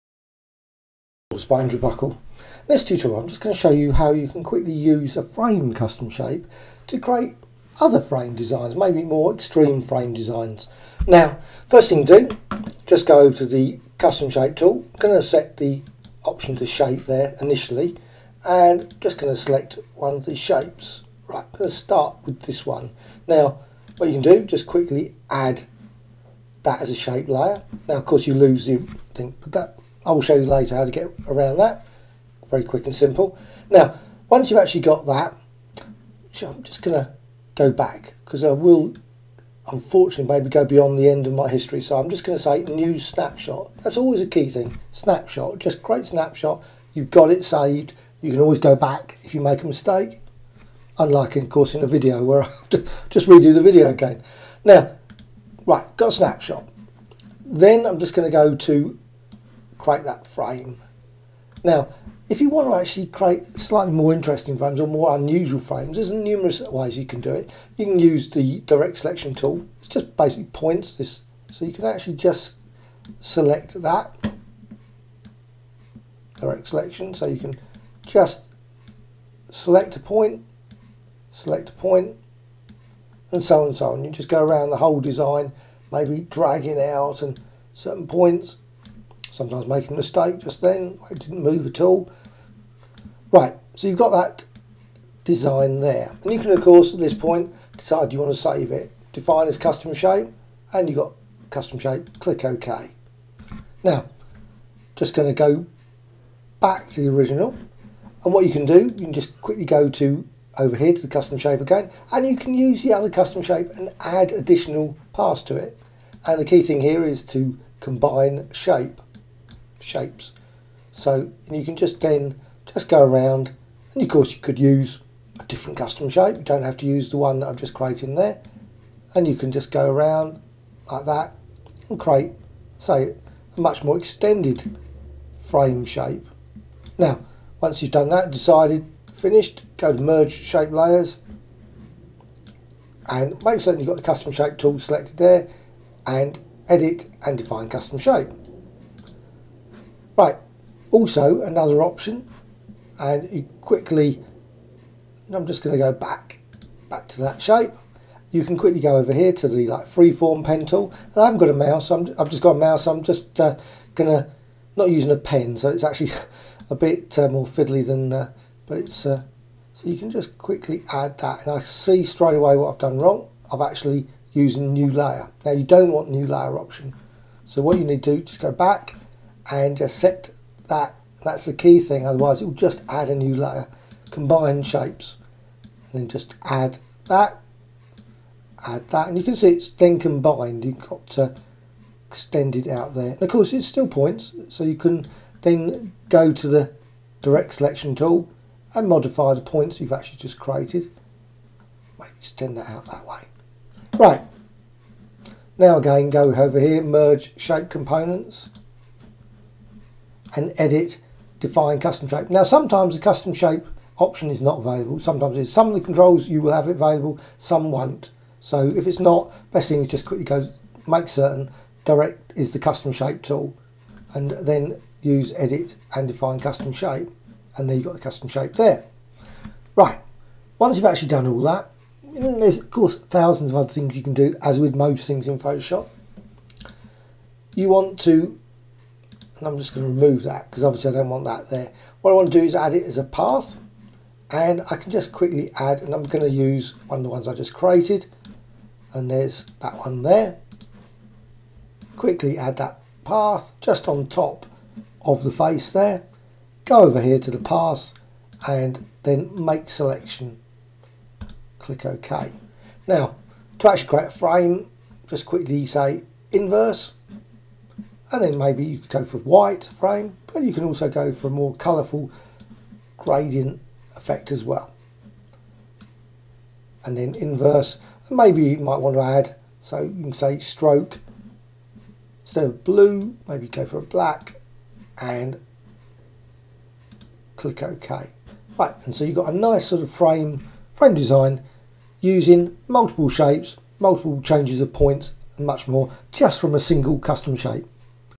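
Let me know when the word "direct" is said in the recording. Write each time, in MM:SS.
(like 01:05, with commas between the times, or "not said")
01:08, 01:16, 03:17, 03:41.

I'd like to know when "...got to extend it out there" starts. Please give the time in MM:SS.
03:10.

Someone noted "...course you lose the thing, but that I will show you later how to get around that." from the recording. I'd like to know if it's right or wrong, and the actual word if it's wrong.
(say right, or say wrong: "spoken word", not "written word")
right.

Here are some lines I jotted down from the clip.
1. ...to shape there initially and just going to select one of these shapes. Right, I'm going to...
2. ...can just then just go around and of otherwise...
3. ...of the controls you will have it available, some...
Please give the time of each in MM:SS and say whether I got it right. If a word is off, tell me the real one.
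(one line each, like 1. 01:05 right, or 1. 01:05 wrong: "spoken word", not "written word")
1. 00:16 right
2. 02:01 wrong: "course", not "otherwise"
3. 03:35 right.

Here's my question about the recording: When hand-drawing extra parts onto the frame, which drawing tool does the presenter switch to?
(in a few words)
Freeform pen tool.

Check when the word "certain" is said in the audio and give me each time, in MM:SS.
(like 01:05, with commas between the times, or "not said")
01:27, 02:23, 03:41.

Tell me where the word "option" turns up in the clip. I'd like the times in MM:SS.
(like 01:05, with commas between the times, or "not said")
00:16, 02:31, 02:56, 03:33.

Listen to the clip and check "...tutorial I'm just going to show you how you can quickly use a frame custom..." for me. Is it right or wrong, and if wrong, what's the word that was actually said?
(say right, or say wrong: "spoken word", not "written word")
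right.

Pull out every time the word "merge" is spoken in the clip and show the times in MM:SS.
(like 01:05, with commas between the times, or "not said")
02:20, 03:26.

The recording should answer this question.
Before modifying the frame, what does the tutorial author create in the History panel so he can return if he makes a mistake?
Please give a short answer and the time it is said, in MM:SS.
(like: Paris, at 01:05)
New snapshot, at 00:42.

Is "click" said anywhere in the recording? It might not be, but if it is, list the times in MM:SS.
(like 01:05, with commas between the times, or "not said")
01:42, 04:21, 04:47.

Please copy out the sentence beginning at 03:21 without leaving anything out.
Maybe extend that out that way.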